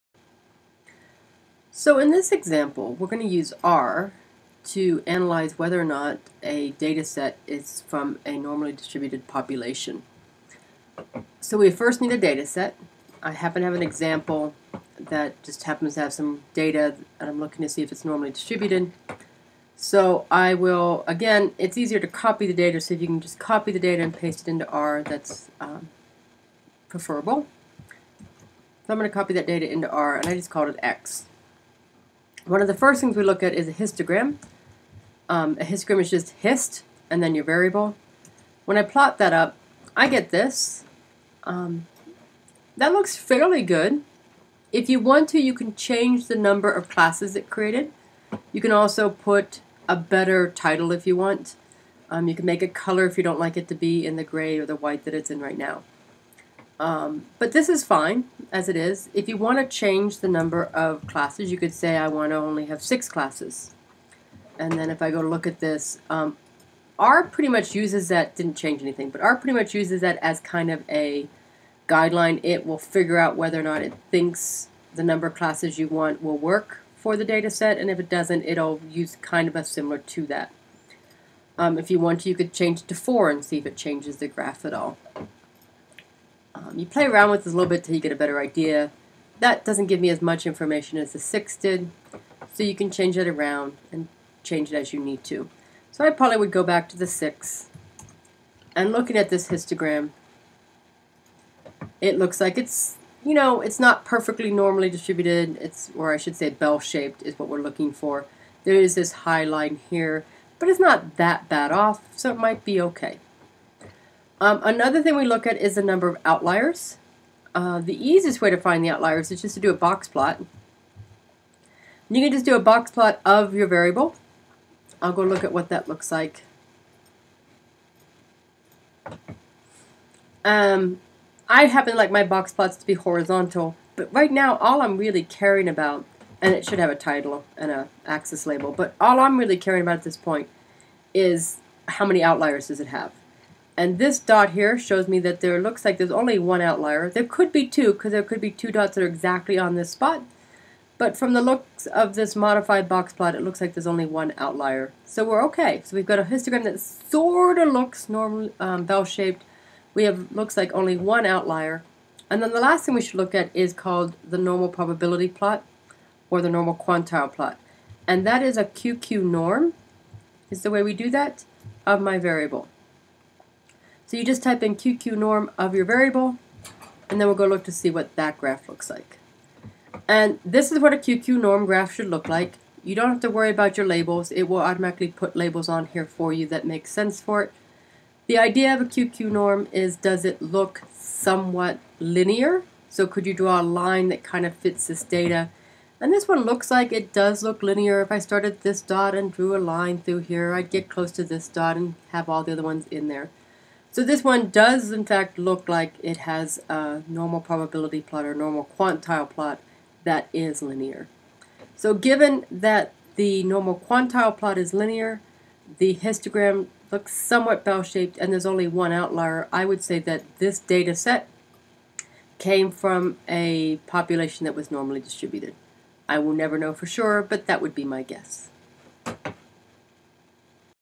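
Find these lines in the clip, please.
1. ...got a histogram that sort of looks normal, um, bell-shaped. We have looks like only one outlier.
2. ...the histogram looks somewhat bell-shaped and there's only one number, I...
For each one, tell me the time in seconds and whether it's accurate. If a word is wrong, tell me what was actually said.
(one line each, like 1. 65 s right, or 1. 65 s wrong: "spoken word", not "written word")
1. 156 s right
2. 215 s wrong: "outlier", not "number".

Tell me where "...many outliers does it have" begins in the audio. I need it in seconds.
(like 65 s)
142 s.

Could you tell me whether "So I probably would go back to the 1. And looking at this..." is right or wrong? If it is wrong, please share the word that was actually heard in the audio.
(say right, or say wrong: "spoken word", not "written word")
wrong: "6", not "1".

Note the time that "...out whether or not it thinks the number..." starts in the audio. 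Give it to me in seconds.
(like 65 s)
73 s.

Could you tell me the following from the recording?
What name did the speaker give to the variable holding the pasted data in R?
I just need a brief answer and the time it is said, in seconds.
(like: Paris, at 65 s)
X, at 30 s.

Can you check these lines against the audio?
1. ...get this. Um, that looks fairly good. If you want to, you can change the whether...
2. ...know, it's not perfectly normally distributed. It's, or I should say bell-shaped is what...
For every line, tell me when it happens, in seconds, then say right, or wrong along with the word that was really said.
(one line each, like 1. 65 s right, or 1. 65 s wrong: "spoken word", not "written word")
1. 40 s wrong: "number", not "whether"
2. 103 s right.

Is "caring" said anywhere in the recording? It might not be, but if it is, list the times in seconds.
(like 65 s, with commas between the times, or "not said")
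135 s, 139 s.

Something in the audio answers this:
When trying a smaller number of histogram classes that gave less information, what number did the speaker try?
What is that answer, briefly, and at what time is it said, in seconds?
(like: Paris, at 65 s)
4, at 82 s.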